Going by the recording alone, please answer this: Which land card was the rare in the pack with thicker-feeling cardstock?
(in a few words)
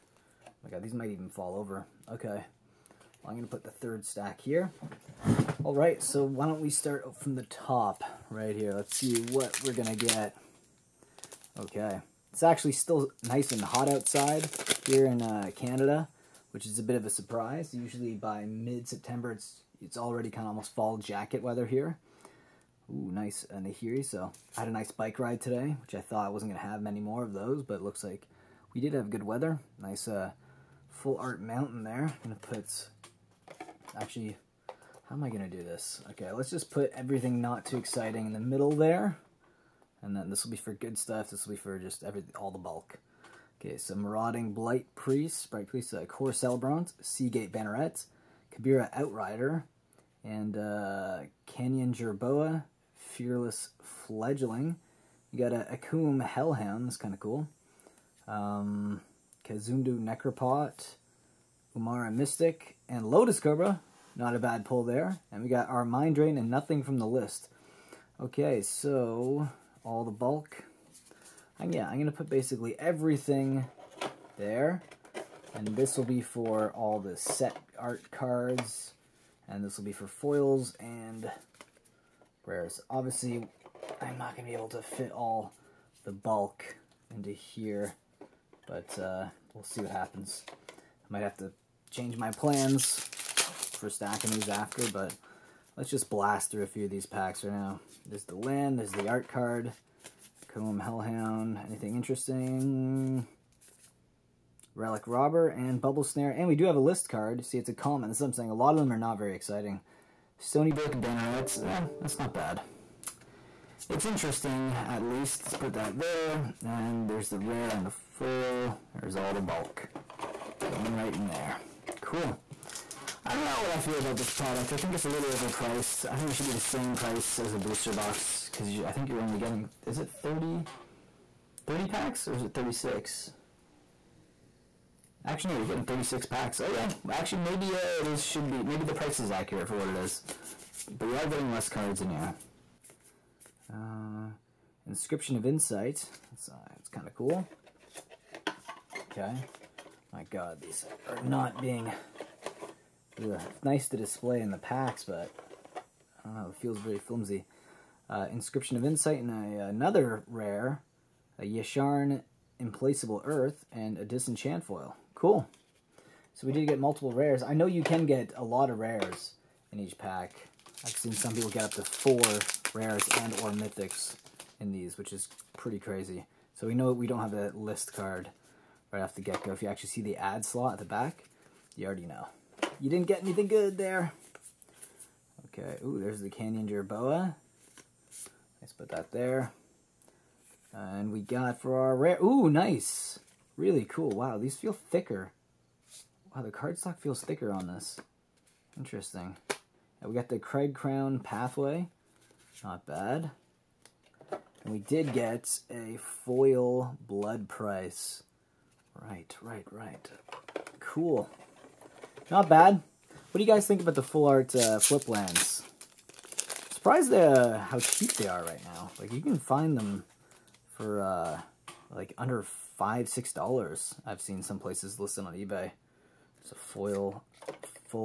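Cragcrown Pathway.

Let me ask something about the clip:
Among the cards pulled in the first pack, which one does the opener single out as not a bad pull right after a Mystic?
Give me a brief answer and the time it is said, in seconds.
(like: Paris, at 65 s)
Lotus Cobra, at 63 s.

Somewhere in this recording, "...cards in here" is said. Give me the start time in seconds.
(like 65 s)
141 s.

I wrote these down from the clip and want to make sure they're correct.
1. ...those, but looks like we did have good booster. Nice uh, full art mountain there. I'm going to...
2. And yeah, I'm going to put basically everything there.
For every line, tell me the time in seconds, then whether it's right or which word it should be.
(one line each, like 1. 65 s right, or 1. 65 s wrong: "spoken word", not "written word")
1. 27 s wrong: "weather", not "booster"
2. 71 s right.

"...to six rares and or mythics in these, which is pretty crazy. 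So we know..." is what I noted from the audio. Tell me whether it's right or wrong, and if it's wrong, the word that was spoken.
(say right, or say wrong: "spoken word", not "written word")
wrong: "four", not "six".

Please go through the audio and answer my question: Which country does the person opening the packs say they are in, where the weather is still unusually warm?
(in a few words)
Canada.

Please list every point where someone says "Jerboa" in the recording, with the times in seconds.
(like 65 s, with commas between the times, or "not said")
51 s, 186 s.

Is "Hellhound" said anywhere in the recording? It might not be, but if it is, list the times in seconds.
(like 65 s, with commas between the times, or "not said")
56 s, 100 s.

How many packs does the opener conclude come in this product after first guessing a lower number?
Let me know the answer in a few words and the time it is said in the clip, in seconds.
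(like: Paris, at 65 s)
36, at 135 s.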